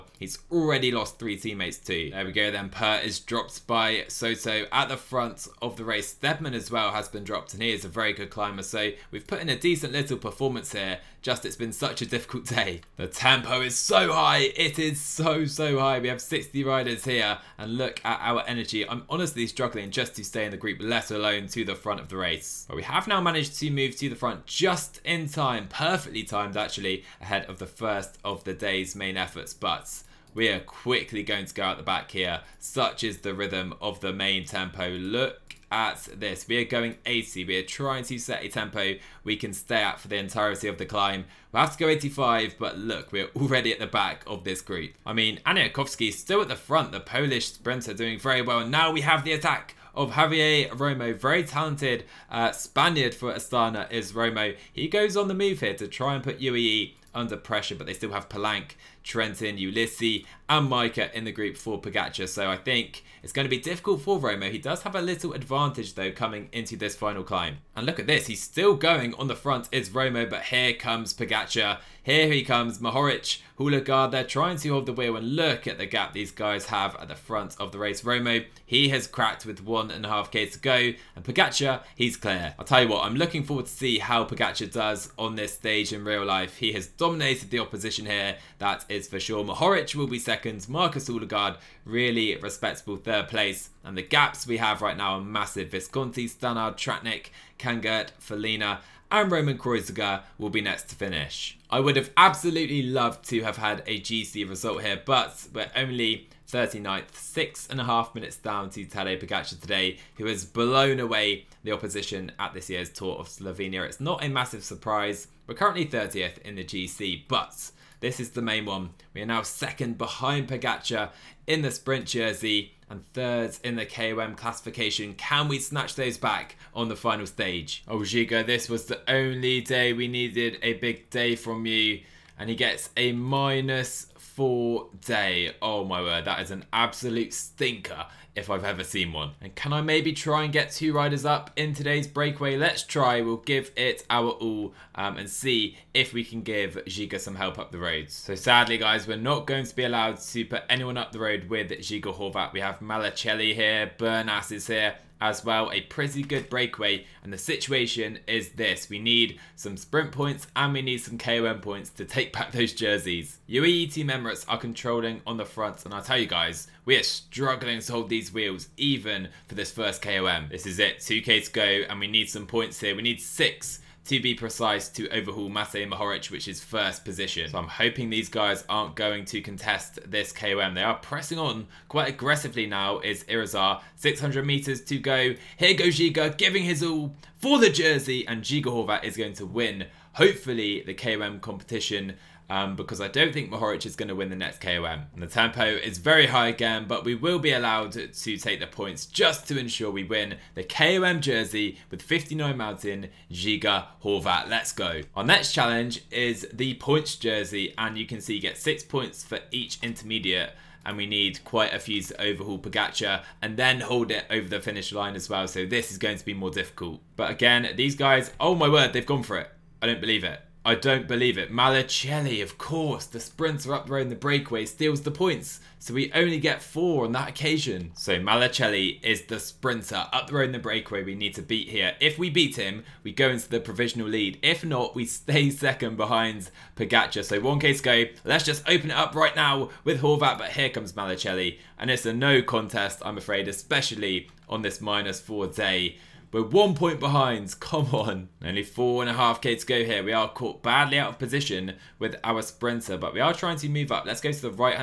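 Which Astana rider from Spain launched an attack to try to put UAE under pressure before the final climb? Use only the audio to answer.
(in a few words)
Javier Romo.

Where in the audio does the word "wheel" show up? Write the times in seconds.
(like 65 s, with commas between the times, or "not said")
74 s, 168 s.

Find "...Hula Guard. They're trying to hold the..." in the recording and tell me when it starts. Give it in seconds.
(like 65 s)
73 s.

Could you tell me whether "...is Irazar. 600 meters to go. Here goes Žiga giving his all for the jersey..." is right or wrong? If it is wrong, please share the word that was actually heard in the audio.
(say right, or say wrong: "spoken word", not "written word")
right.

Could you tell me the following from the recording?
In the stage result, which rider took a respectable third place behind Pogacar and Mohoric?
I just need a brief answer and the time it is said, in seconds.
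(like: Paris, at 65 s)
Markus Hoelgaard, at 90 s.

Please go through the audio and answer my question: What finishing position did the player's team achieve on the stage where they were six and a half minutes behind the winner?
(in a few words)
39th.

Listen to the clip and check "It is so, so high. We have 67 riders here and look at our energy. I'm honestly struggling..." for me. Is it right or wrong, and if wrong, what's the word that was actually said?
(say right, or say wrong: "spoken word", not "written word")
wrong: "60", not "67".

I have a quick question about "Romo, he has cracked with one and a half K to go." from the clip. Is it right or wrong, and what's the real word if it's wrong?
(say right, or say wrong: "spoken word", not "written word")
right.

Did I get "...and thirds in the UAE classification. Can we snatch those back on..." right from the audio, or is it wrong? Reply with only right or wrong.
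wrong.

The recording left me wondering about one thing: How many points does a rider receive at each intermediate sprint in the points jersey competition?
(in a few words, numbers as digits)
6.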